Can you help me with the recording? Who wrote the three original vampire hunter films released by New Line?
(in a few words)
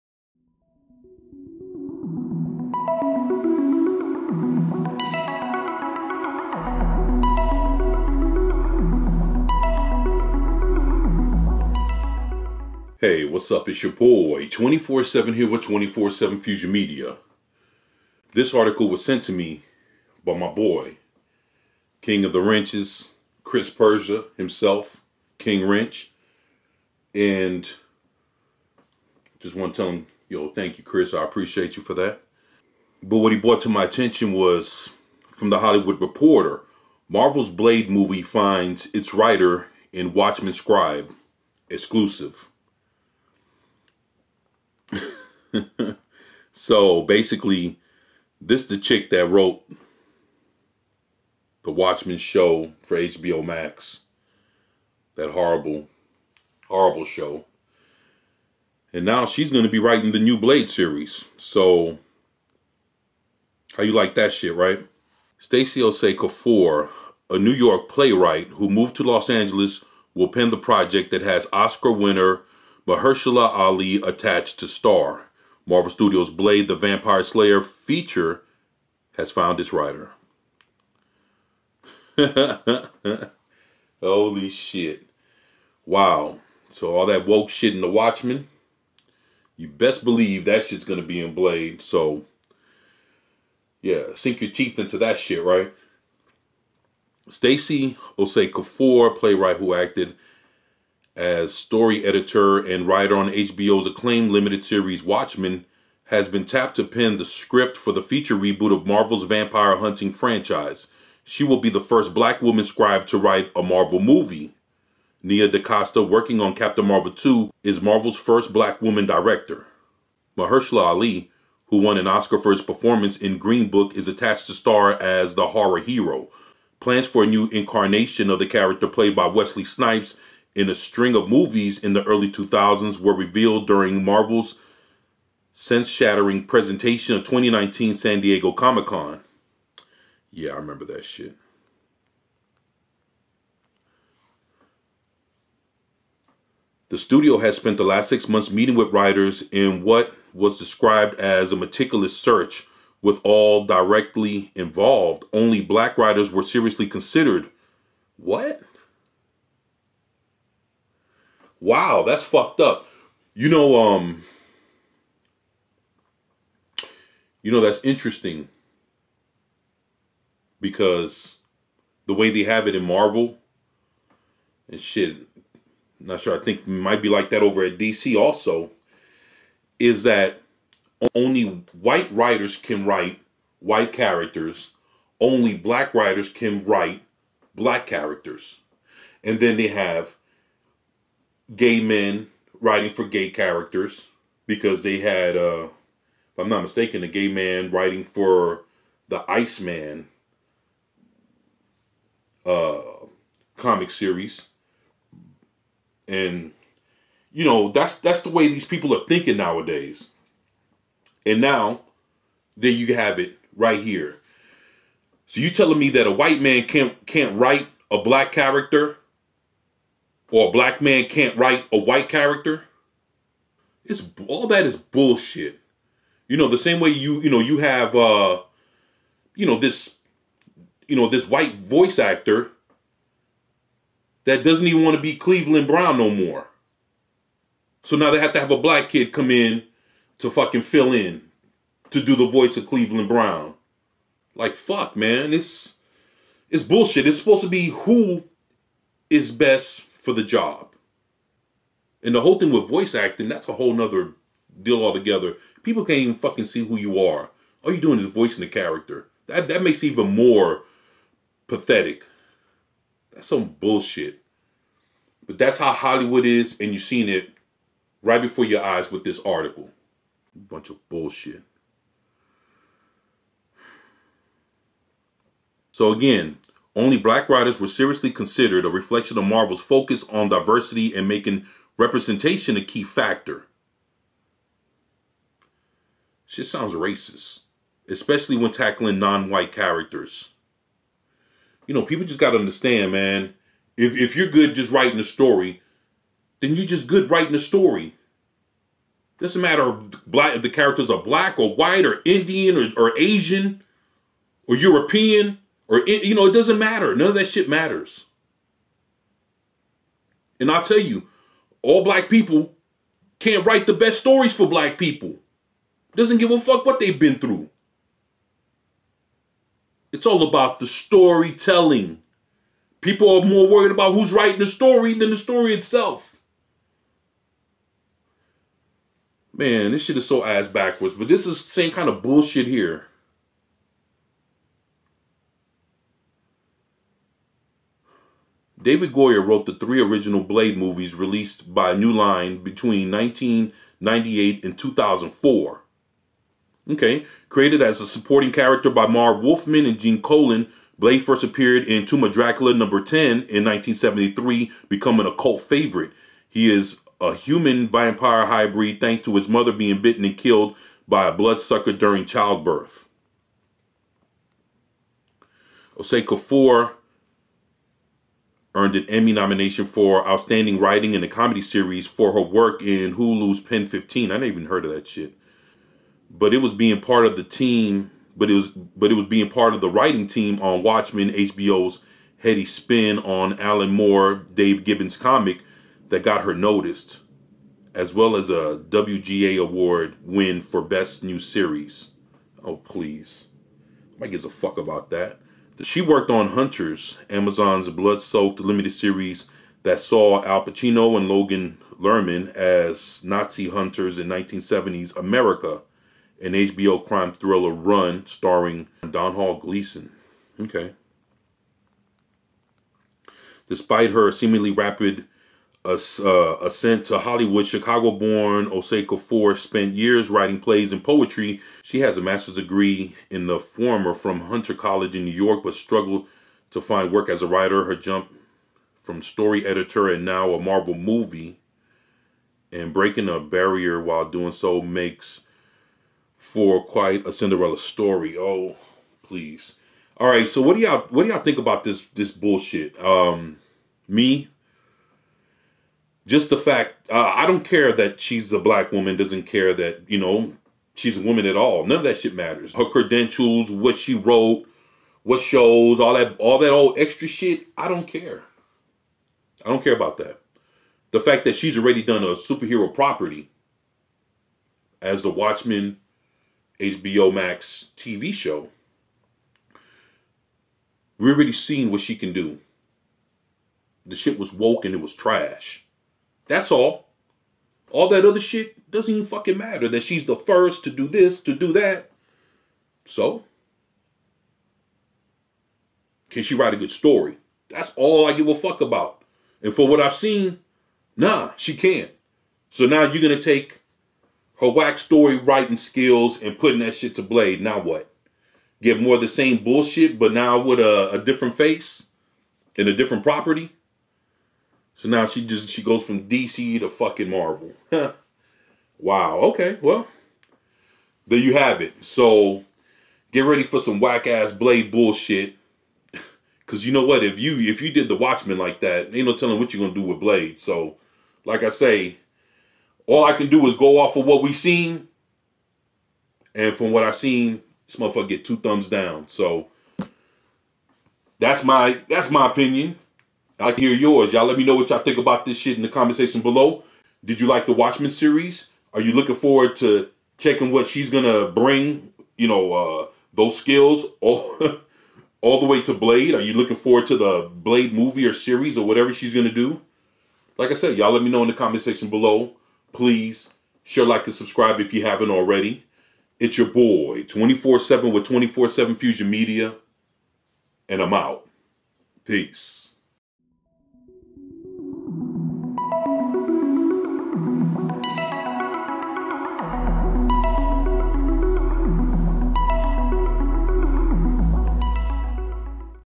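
David Goyer.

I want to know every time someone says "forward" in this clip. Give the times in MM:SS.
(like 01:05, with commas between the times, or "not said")
08:59, 09:06.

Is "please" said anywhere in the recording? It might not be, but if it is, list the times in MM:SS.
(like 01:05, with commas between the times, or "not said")
06:32, 07:19, 09:12.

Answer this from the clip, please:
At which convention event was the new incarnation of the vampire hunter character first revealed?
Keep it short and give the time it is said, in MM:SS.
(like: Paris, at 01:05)
2019 San Diego Comic Con, at 02:17.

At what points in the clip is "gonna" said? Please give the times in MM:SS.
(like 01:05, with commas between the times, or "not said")
08:39, 09:00, 09:09.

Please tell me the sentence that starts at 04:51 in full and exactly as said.
You know, people just got to understand, man.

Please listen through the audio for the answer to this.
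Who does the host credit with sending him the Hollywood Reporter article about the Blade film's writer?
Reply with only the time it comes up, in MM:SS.
00:23.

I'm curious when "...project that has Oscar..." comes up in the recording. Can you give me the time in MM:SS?
01:10.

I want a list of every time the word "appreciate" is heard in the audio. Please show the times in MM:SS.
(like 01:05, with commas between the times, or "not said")
00:31.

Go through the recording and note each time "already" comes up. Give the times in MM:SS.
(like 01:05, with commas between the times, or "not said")
07:41, 07:51, 09:15.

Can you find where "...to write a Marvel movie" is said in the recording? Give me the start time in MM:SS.
01:53.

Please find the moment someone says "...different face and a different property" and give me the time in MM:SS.
08:20.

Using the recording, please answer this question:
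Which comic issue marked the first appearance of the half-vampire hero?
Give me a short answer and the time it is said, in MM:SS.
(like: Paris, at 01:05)
Tomb of Dracula number 10, at 05:51.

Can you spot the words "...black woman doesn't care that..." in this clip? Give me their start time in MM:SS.
07:28.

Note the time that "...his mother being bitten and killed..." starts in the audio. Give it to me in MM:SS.
05:59.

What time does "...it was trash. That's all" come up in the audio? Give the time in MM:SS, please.
07:54.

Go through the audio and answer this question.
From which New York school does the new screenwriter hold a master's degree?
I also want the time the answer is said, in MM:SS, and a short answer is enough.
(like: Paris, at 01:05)
Hunter College, at 07:04.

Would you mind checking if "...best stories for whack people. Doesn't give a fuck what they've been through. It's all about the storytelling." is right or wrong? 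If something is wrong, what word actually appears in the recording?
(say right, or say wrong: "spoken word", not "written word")
wrong: "black", not "whack".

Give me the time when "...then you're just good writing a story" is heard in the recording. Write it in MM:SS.
04:56.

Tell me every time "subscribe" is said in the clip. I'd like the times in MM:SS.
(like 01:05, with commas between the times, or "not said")
09:14.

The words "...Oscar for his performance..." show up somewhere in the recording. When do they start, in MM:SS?
02:02.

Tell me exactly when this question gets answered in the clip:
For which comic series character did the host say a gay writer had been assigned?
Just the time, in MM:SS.
03:19.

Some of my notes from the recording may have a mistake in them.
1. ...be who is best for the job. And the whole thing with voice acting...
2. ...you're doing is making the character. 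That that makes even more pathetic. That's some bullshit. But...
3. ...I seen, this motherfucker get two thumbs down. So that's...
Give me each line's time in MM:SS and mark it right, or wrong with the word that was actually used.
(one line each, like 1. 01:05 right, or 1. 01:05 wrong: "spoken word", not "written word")
1. 04:07 right
2. 04:17 wrong: "voicing", not "making"
3. 08:46 right.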